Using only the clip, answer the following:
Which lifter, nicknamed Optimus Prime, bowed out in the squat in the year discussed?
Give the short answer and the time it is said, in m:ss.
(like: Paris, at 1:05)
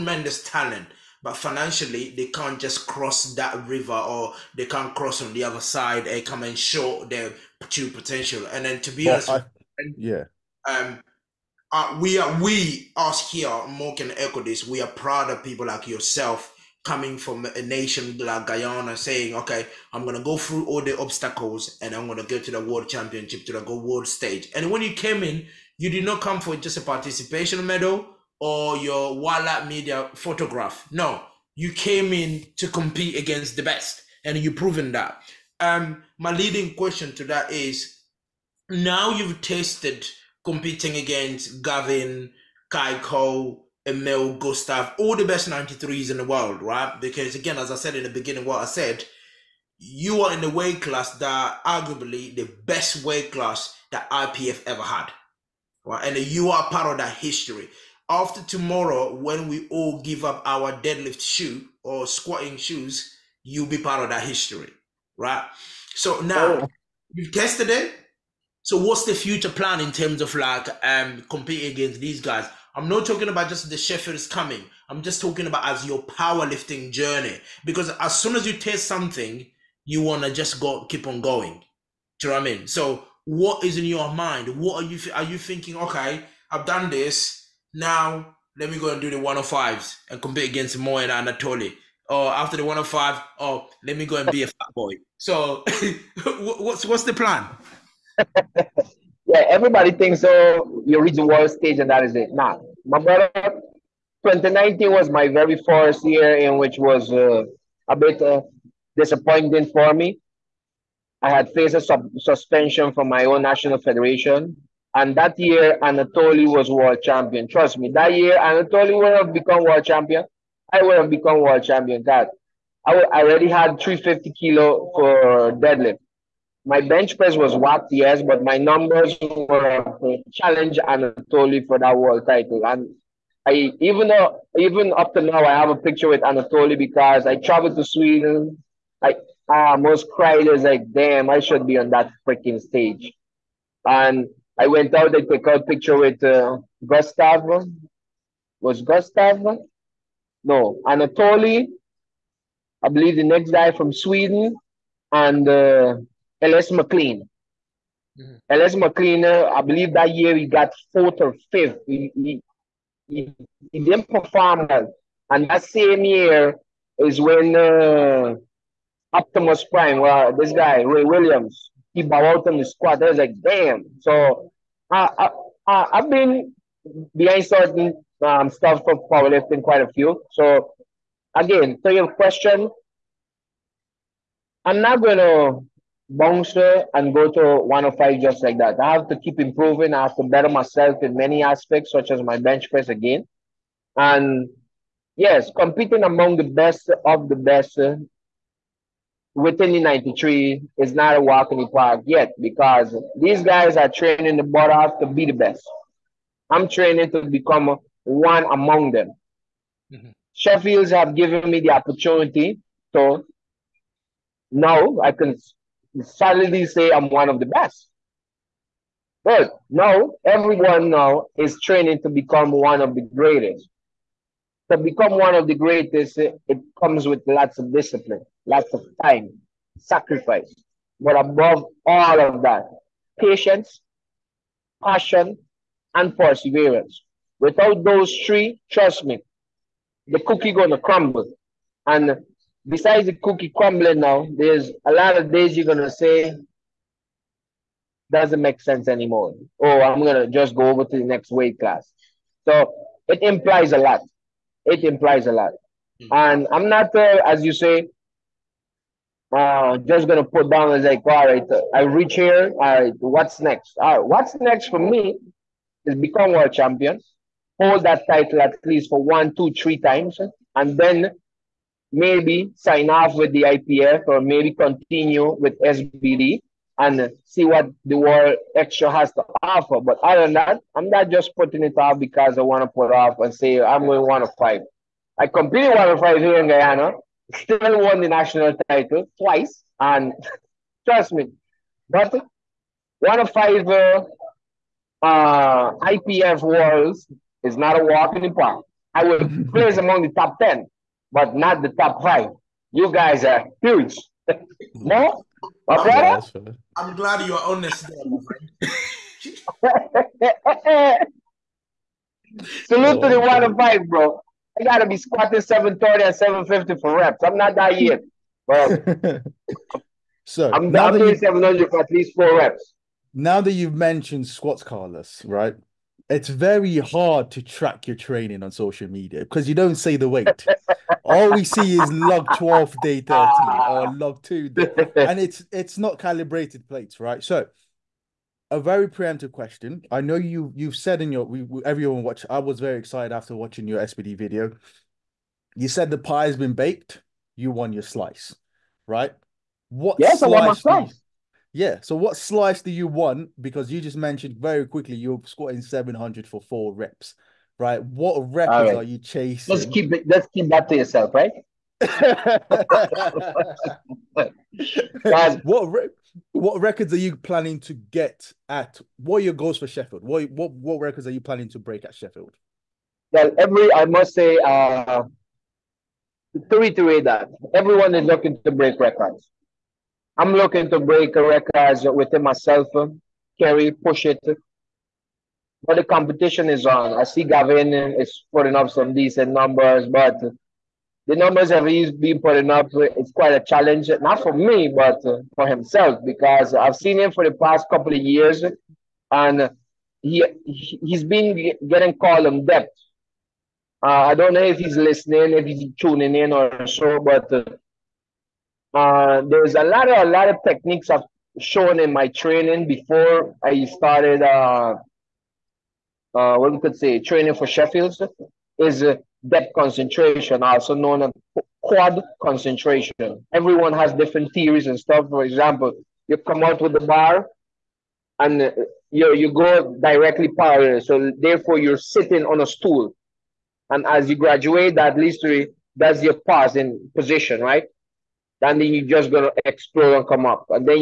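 Ray Williams, at 2:50.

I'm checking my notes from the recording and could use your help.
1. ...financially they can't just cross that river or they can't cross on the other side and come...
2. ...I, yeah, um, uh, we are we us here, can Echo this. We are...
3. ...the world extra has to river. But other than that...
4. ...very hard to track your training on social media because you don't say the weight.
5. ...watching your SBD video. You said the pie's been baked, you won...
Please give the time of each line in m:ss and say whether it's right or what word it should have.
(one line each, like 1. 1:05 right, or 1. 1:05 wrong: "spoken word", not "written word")
1. 0:01 right
2. 0:09 right
3. 4:37 wrong: "offer", not "river"
4. 5:26 right
5. 5:43 right.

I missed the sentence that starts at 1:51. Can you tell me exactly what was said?
I had faced a sub- suspension from my own national federation, and that year Anatoly was world champion.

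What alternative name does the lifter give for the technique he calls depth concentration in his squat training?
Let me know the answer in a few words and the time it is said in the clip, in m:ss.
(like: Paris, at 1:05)
quad concentration, at 7:01.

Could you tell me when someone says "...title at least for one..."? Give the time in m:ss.
4:28.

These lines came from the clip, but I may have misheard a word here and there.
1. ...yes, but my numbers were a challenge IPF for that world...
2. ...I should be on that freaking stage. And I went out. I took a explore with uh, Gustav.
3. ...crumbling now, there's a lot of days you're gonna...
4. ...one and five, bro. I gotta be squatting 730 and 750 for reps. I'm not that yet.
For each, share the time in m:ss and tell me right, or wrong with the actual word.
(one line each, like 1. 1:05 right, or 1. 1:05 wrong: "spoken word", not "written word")
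1. 2:07 wrong: "Anatoly", not "IPF"
2. 2:21 wrong: "picture", not "explore"
3. 4:03 right
4. 5:13 right.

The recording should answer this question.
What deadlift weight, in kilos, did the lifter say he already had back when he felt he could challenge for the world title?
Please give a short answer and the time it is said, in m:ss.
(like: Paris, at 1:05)
350, at 2:03.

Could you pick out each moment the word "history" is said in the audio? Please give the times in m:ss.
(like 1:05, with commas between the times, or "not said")
0:57, 1:04.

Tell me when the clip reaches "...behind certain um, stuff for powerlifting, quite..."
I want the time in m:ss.
2:57.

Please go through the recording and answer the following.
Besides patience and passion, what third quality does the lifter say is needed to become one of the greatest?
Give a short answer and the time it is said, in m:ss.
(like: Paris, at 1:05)
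perseverance, at 3:56.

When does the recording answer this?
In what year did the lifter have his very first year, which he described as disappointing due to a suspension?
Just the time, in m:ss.
1:44.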